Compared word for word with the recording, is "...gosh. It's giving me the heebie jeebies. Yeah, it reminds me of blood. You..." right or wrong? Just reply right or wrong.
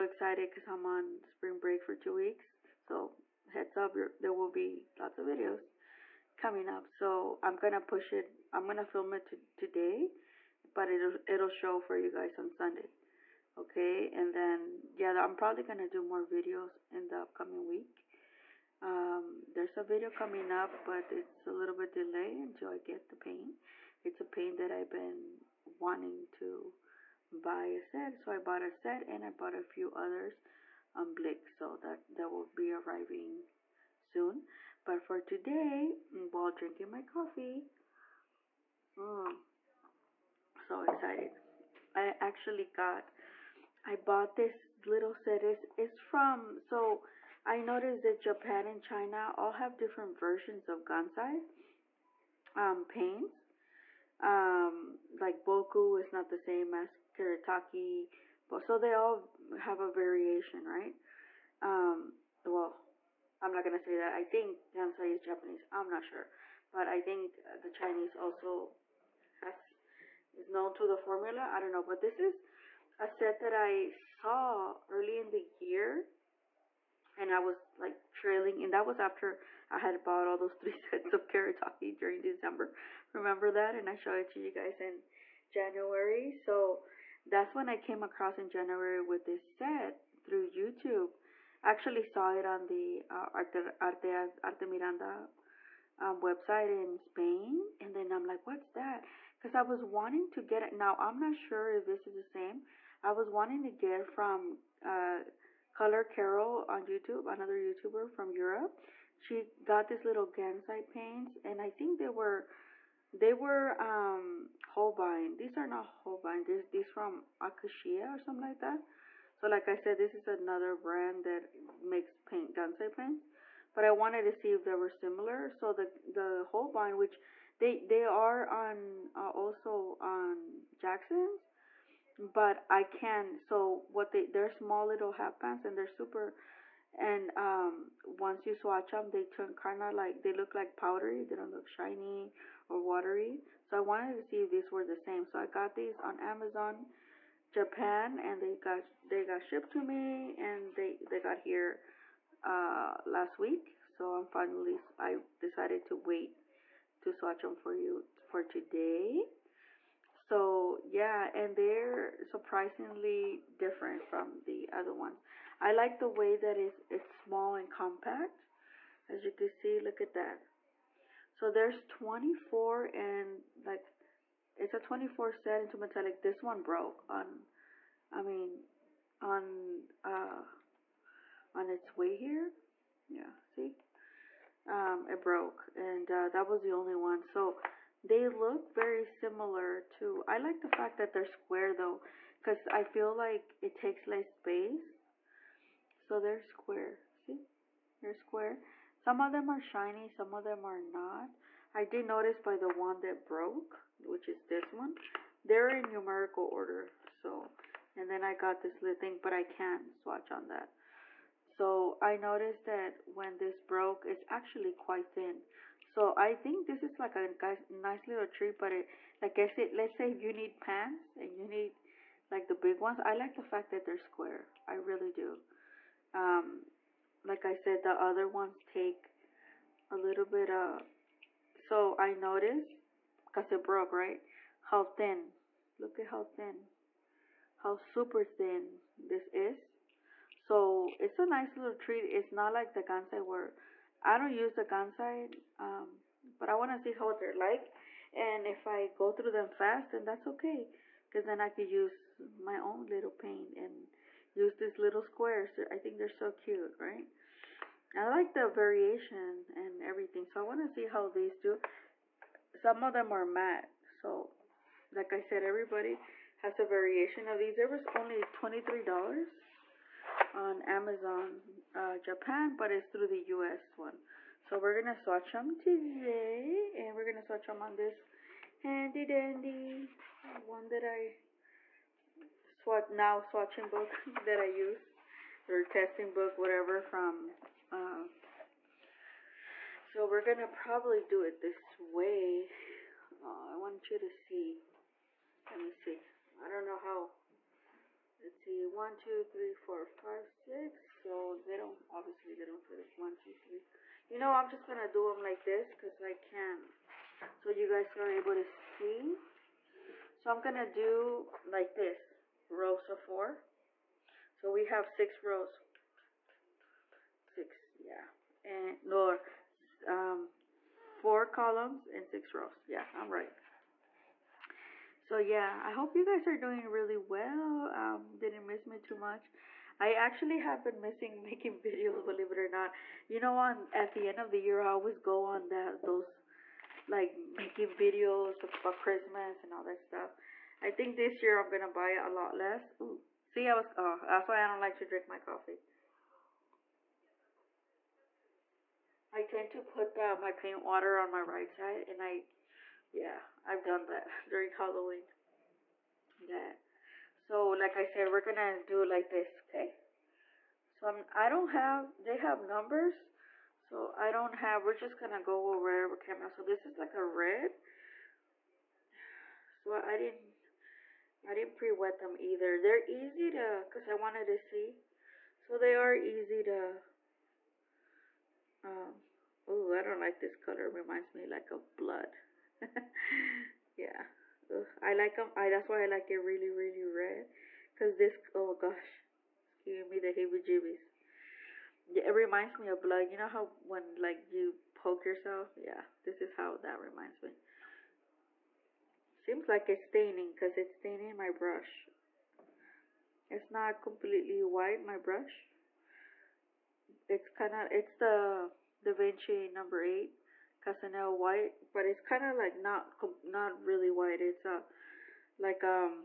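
right.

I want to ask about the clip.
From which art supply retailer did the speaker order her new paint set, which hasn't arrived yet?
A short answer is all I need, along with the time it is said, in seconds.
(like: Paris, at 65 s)
Blick, at 31 s.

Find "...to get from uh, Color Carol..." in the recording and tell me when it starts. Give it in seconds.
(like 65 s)
103 s.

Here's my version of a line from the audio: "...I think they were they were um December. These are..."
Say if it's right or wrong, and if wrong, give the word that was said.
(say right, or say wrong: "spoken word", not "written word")
wrong: "Holbein", not "December".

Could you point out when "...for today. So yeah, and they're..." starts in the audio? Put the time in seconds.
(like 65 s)
158 s.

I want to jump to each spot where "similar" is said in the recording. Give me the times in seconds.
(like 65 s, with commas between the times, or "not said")
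124 s, 189 s.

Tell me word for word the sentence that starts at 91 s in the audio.
I actually saw it on the uh, Arte, Arte, Arte Miranda um, website in Spain.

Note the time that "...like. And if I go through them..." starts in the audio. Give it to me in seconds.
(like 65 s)
247 s.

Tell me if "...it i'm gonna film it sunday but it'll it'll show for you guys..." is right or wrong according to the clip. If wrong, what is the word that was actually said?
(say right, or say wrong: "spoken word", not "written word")
wrong: "today", not "sunday".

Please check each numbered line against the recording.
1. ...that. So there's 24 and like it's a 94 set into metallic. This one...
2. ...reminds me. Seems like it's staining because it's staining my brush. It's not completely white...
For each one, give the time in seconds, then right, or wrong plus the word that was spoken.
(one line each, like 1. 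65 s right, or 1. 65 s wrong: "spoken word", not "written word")
1. 170 s wrong: "24", not "94"
2. 396 s right.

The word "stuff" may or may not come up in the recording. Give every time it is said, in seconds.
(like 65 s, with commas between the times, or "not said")
339 s.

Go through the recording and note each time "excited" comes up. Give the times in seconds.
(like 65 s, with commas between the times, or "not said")
40 s.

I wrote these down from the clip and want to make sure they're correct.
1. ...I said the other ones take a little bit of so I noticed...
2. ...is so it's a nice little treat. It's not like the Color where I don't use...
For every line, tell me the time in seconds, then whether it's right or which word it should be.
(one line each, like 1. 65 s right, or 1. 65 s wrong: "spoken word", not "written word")
1. 227 s right
2. 239 s wrong: "Gansai", not "Color".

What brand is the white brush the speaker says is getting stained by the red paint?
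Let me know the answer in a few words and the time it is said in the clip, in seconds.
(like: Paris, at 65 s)
Da Vinci, at 408 s.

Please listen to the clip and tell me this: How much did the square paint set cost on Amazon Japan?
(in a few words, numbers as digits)
$23.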